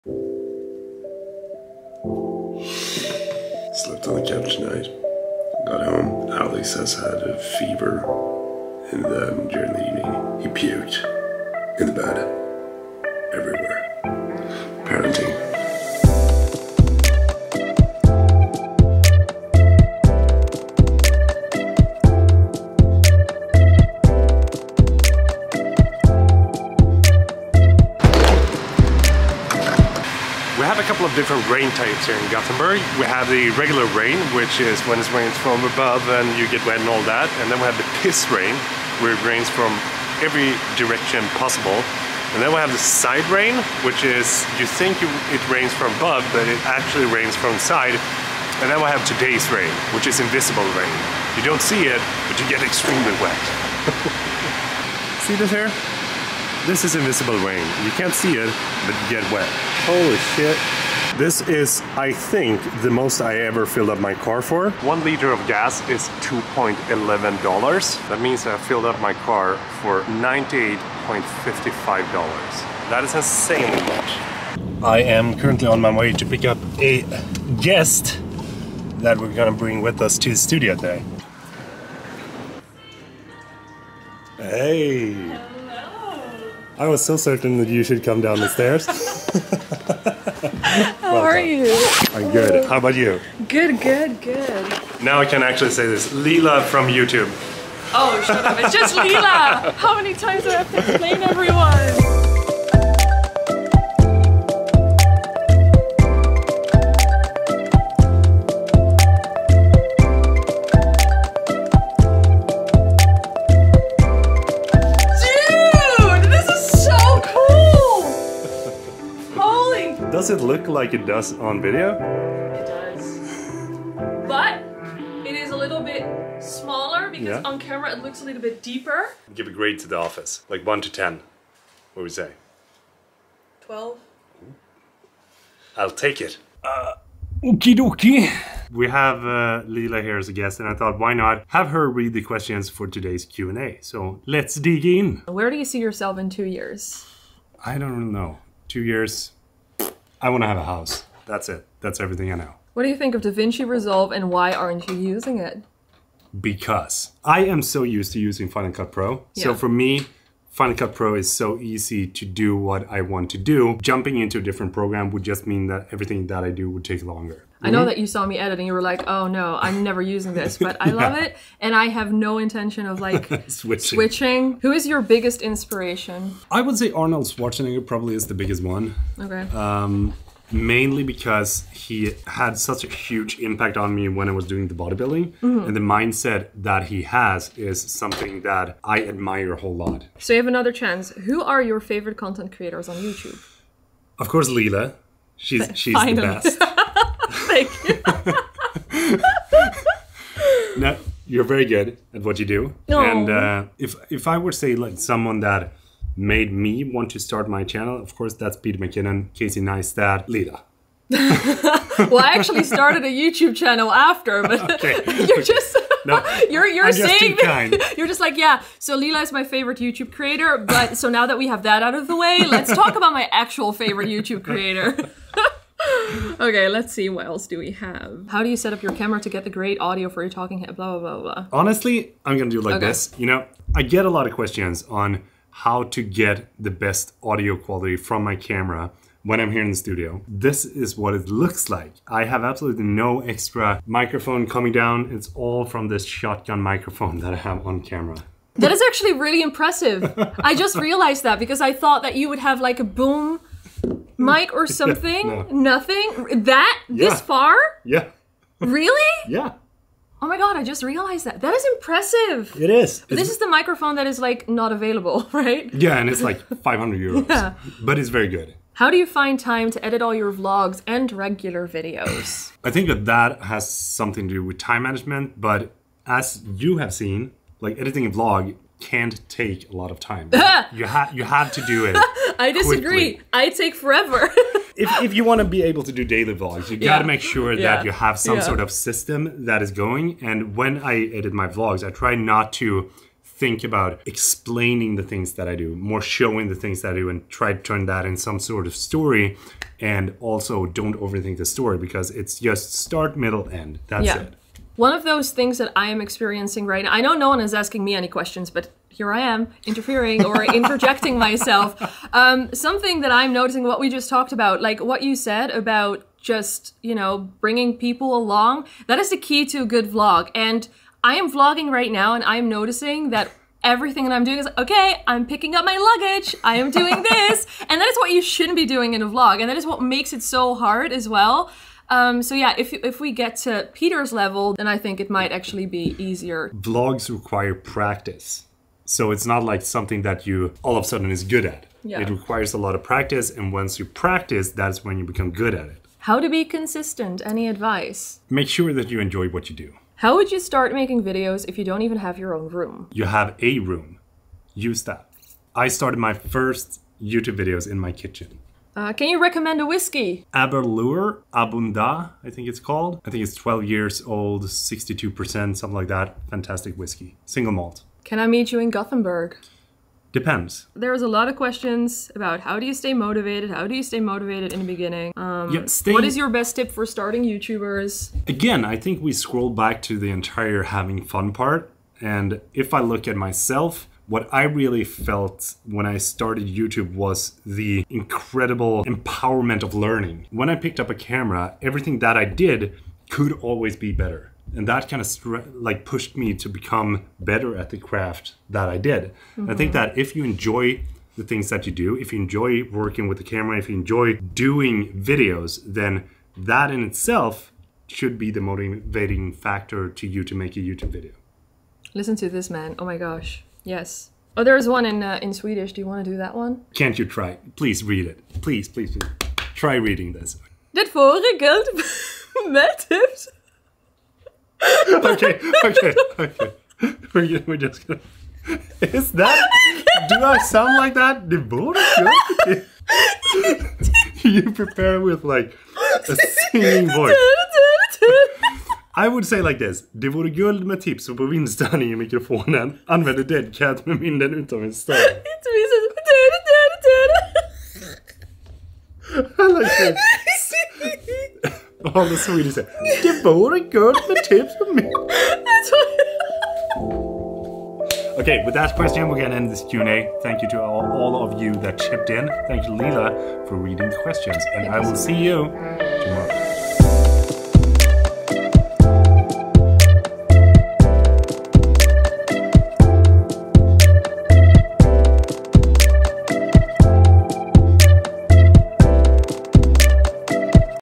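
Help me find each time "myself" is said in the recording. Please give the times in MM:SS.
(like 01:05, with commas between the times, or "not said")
05:11, 06:23.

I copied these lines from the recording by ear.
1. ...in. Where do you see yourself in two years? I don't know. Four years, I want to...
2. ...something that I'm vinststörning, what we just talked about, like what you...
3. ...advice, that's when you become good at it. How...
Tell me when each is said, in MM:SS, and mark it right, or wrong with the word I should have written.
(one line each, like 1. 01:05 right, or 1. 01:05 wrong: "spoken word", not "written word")
1. 02:24 wrong: "Two", not "Four"
2. 05:12 wrong: "noticing", not "vinststörning"
3. 05:43 wrong: "practice", not "advice".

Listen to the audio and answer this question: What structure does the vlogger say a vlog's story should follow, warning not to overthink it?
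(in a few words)
Start, middle, end.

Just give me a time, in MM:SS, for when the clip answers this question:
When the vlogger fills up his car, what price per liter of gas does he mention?
01:06.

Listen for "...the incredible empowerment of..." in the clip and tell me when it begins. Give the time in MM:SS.
06:27.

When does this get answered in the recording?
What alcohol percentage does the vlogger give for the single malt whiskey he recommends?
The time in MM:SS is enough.
06:04.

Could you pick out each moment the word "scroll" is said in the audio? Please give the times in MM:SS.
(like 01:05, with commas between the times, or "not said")
06:19.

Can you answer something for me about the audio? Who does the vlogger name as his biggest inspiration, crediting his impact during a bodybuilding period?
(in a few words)
Arnold Schwarzenegger.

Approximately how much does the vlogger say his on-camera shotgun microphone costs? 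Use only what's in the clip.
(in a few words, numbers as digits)
500 euros.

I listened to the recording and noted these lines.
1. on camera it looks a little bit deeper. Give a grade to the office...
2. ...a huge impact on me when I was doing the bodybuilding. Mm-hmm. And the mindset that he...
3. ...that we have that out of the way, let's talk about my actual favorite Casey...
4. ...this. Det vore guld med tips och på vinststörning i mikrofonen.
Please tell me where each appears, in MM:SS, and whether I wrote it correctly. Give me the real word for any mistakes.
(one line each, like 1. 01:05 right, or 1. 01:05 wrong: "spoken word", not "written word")
1. 02:07 right
2. 03:02 right
3. 03:41 wrong: "YouTube", not "Casey"
4. 07:19 right.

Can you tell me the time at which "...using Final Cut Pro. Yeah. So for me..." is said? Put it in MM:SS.
02:38.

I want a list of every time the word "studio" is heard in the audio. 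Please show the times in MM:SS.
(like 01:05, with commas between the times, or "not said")
01:20, 03:59.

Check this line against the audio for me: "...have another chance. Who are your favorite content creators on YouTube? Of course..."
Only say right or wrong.
right.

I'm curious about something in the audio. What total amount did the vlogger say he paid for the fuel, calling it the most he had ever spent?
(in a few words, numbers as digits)
$98.55.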